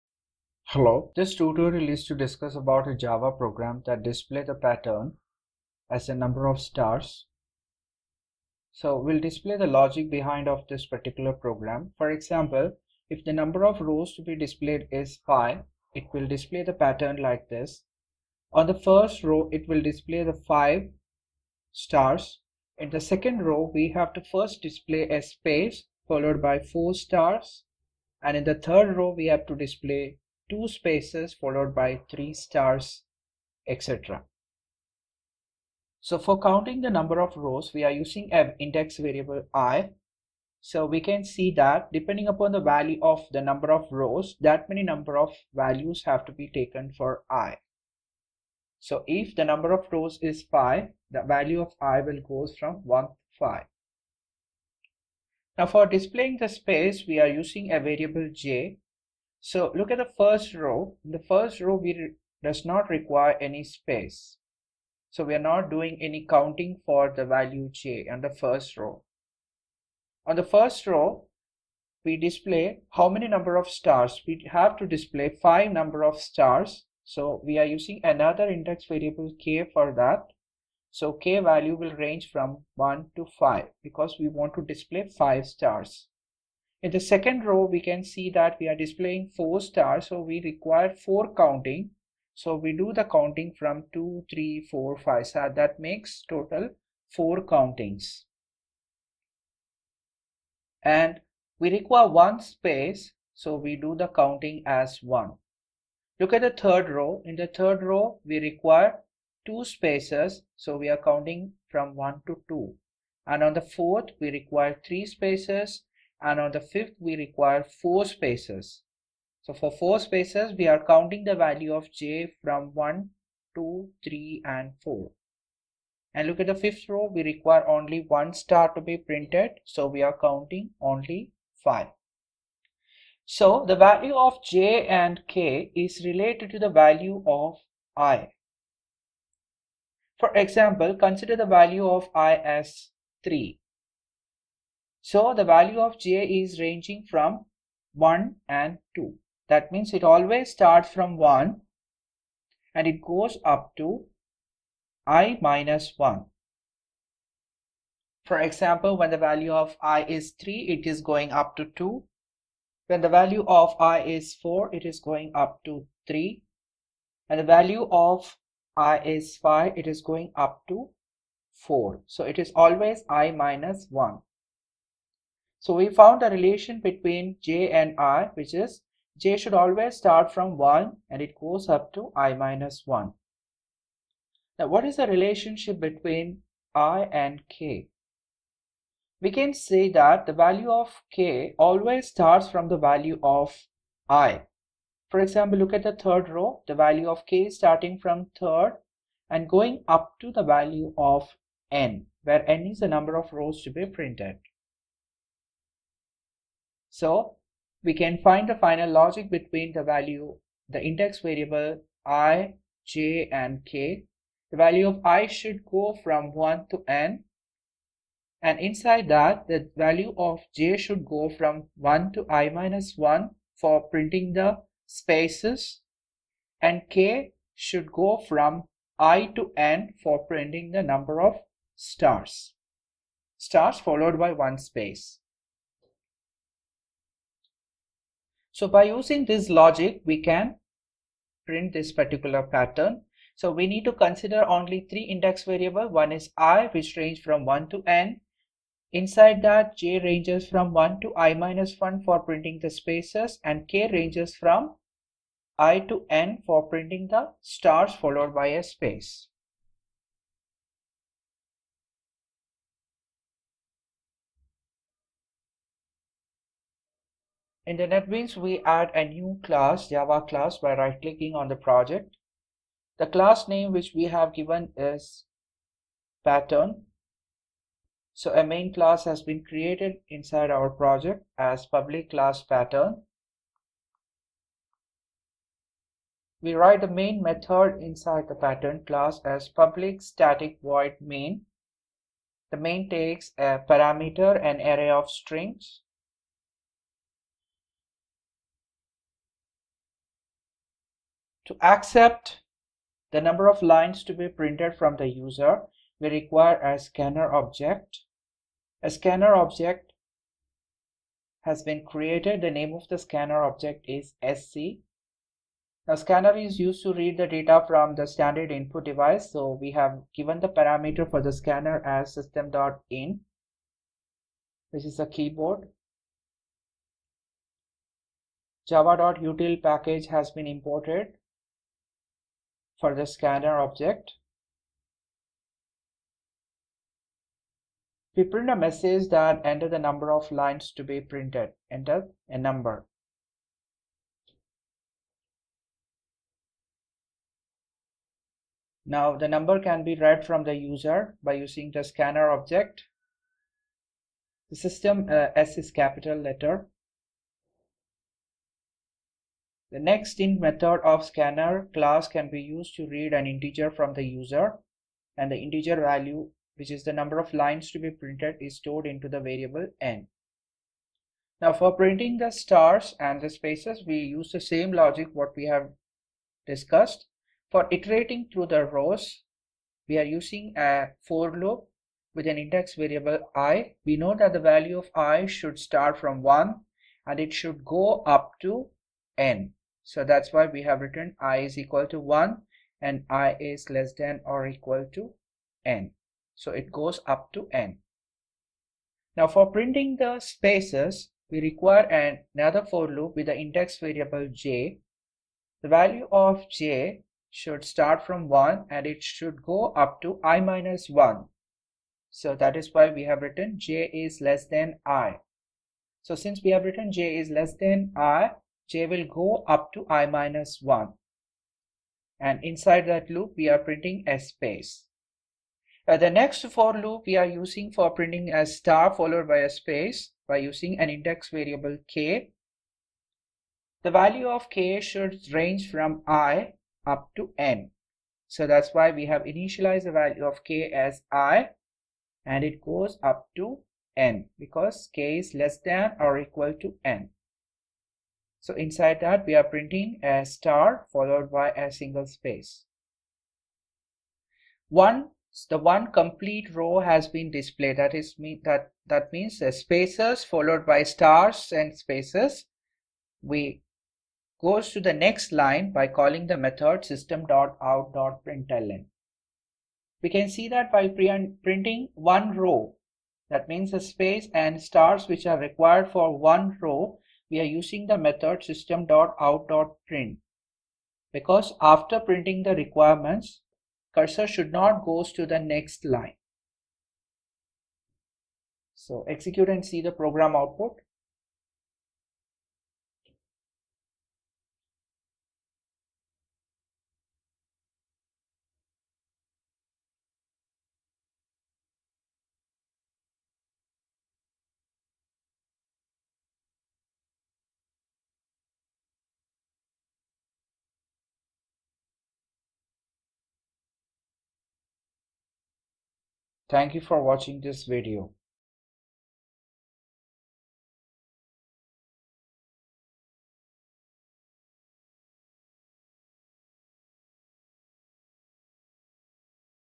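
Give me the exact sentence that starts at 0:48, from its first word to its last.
So if the number of rows is 5, the value of i will go from 1 to 5.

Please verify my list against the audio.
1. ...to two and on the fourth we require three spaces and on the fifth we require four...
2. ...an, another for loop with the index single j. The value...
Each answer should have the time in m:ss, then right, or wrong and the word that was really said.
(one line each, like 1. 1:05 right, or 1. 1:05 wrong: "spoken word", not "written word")
1. 1:52 right
2. 6:41 wrong: "variable", not "single".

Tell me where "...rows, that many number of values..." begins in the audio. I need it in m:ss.
0:43.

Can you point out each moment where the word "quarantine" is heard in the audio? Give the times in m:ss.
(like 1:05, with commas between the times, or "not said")
not said.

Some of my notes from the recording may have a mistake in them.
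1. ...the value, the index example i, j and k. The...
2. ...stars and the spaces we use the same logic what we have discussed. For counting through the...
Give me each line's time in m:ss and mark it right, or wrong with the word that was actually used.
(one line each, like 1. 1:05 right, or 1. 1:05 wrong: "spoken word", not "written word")
1. 3:29 wrong: "variable", not "example"
2. 6:12 wrong: "iterating", not "counting".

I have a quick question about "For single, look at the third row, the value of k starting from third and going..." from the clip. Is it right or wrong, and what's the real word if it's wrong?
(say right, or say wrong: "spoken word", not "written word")
wrong: "example", not "single".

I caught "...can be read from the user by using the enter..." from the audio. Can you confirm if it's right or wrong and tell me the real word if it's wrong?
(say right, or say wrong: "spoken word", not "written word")
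wrong: "scanner", not "enter".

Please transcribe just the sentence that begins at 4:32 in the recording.
The class name which we have given is pattern.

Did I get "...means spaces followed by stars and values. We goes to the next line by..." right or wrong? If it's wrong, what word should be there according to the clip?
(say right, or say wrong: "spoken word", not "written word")
wrong: "spaces", not "values".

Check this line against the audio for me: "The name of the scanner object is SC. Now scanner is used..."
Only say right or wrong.
right.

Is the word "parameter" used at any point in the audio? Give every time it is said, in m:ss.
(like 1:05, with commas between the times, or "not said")
4:53, 5:20.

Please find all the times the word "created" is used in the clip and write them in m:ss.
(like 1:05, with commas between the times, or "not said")
4:39, 5:11.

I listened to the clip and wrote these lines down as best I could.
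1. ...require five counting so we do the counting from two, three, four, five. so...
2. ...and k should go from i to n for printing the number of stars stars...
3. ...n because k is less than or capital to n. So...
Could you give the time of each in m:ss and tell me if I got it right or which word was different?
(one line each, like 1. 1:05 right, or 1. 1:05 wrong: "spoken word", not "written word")
1. 1:30 wrong: "four", not "five"
2. 3:46 right
3. 7:23 wrong: "equal", not "capital".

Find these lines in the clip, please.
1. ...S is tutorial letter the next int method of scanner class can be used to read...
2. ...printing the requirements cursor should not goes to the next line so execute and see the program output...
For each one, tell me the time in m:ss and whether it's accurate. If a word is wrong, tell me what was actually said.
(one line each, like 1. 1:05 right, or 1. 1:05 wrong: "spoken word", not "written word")
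1. 5:55 wrong: "capital", not "tutorial"
2. 8:01 right.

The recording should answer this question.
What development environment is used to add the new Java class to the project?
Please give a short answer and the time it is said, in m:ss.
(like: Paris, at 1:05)
NetBeans, at 4:27.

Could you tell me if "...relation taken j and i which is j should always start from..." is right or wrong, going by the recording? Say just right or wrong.
wrong.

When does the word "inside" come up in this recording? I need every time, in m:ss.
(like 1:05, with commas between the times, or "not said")
3:38, 4:08, 4:40, 4:47, 7:02, 7:28.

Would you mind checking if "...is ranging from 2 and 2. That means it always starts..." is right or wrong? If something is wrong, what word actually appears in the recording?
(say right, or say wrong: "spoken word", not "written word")
wrong: "1", not "2".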